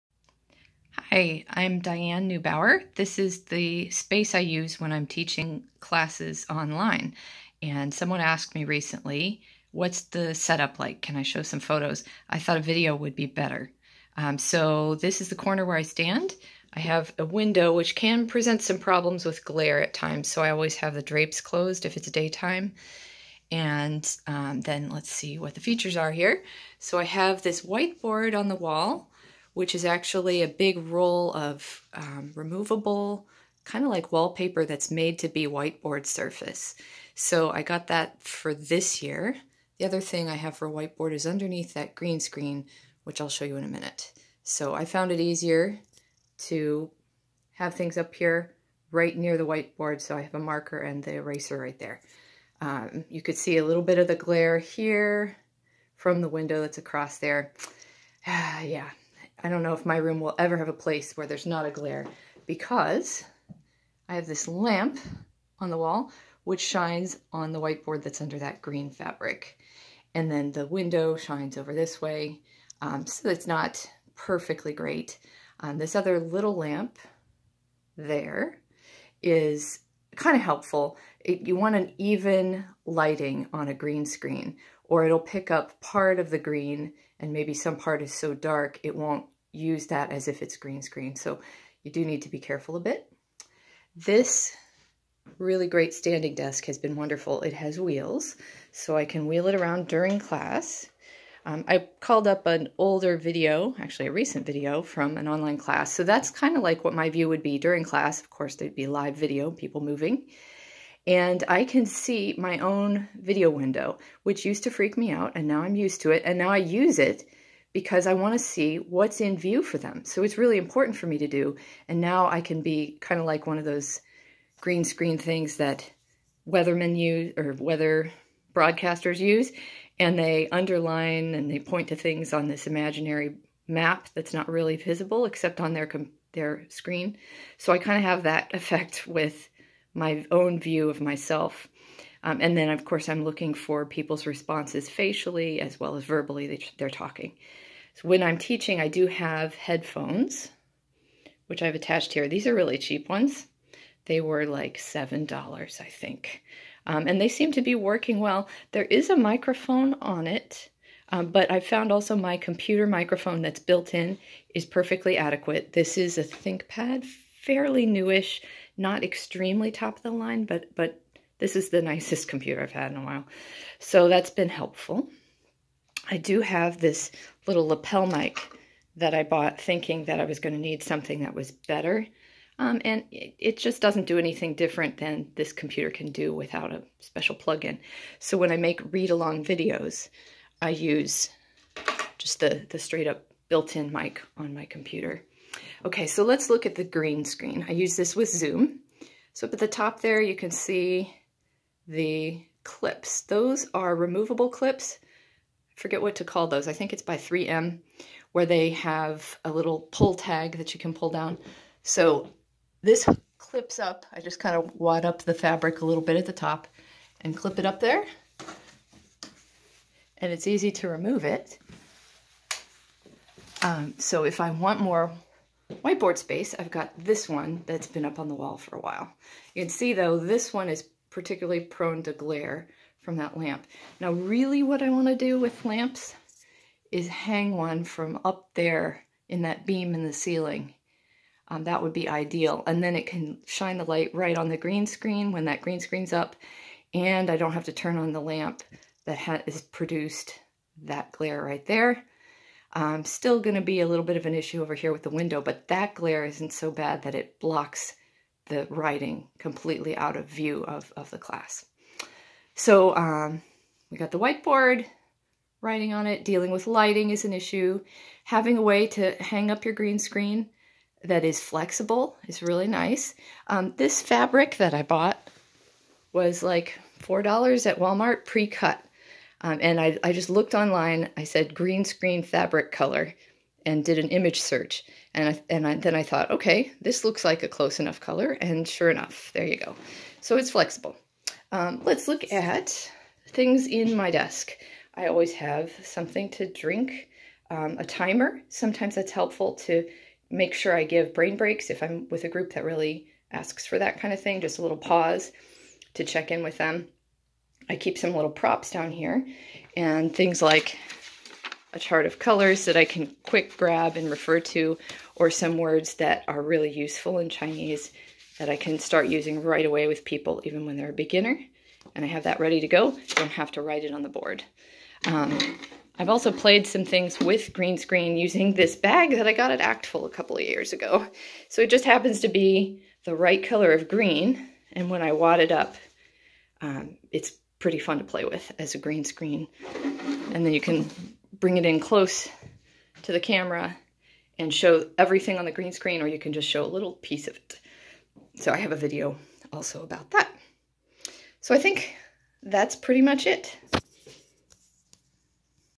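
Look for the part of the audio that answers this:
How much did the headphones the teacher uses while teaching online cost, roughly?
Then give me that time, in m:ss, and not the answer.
2:34.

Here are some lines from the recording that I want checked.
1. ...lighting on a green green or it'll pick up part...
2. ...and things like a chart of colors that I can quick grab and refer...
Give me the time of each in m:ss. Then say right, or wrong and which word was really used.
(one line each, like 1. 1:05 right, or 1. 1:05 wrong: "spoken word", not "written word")
1. 1:22 wrong: "screen", not "green"
2. 5:09 right.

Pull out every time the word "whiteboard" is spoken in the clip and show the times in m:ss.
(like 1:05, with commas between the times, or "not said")
0:27, 0:35, 0:40, 0:49, 1:07, 3:45, 4:24.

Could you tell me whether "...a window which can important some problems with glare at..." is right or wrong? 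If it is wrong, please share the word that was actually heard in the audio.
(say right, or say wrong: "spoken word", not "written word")
wrong: "present", not "important".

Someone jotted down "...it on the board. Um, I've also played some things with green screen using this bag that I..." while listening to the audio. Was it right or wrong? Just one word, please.
right.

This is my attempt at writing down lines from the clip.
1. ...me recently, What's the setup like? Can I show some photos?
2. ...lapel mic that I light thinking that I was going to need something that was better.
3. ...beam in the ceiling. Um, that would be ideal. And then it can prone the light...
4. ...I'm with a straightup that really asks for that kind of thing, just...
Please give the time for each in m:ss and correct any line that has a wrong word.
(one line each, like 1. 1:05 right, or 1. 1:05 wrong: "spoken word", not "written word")
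1. 0:08 right
2. 2:57 wrong: "bought", not "light"
3. 3:59 wrong: "shine", not "prone"
4. 5:01 wrong: "group", not "straightup".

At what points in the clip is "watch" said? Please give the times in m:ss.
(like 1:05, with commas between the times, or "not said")
not said.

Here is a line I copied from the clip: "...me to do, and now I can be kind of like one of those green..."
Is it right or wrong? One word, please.
right.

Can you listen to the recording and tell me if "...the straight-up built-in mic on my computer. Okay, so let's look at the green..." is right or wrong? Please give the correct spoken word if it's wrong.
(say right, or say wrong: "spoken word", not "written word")
right.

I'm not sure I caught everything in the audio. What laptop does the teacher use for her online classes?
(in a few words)
ThinkPad.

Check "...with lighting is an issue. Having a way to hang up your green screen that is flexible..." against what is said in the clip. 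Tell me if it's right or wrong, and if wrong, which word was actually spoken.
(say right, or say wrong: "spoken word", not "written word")
right.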